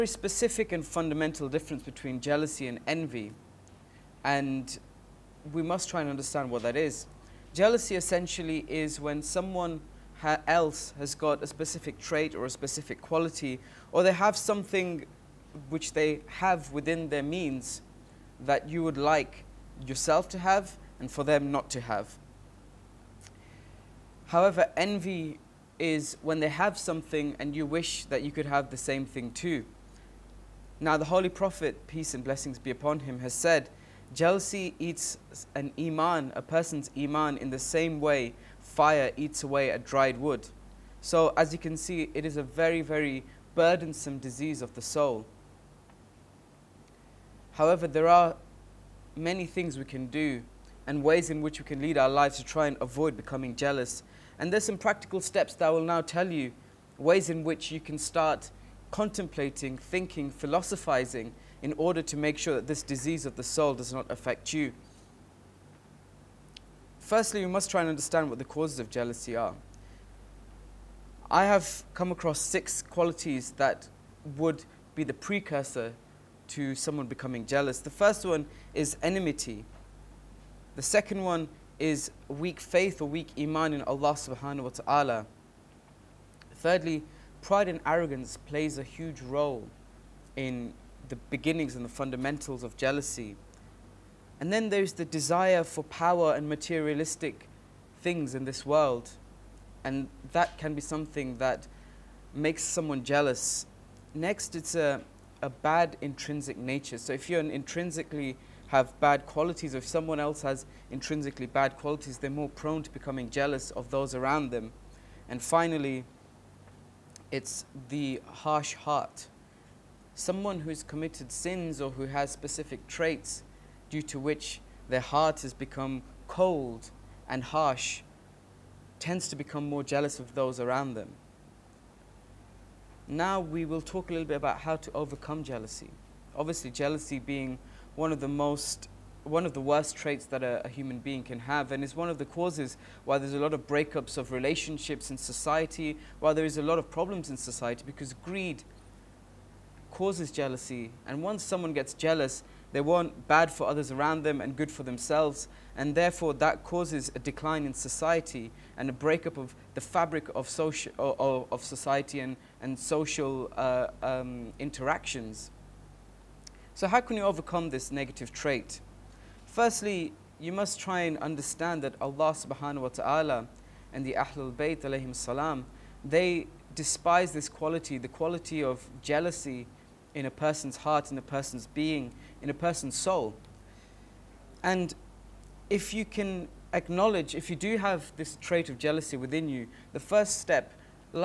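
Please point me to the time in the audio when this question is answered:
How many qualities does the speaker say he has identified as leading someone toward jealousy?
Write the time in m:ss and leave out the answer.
1:12.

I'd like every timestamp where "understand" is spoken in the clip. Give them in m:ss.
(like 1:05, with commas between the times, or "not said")
0:06, 1:07, 2:51.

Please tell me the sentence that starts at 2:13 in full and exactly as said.
Now we will talk a little bit about how to overcome jealousy.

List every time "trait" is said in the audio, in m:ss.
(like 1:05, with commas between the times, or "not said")
0:11, 2:02, 2:19, 2:48, 3:08.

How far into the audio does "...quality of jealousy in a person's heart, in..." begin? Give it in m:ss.
2:58.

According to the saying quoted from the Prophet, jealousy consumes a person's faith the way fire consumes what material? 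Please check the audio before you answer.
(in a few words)
Dried wood.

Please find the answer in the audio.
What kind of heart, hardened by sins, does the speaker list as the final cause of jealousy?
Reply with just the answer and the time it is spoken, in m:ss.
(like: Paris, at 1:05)
Harsh heart, at 1:58.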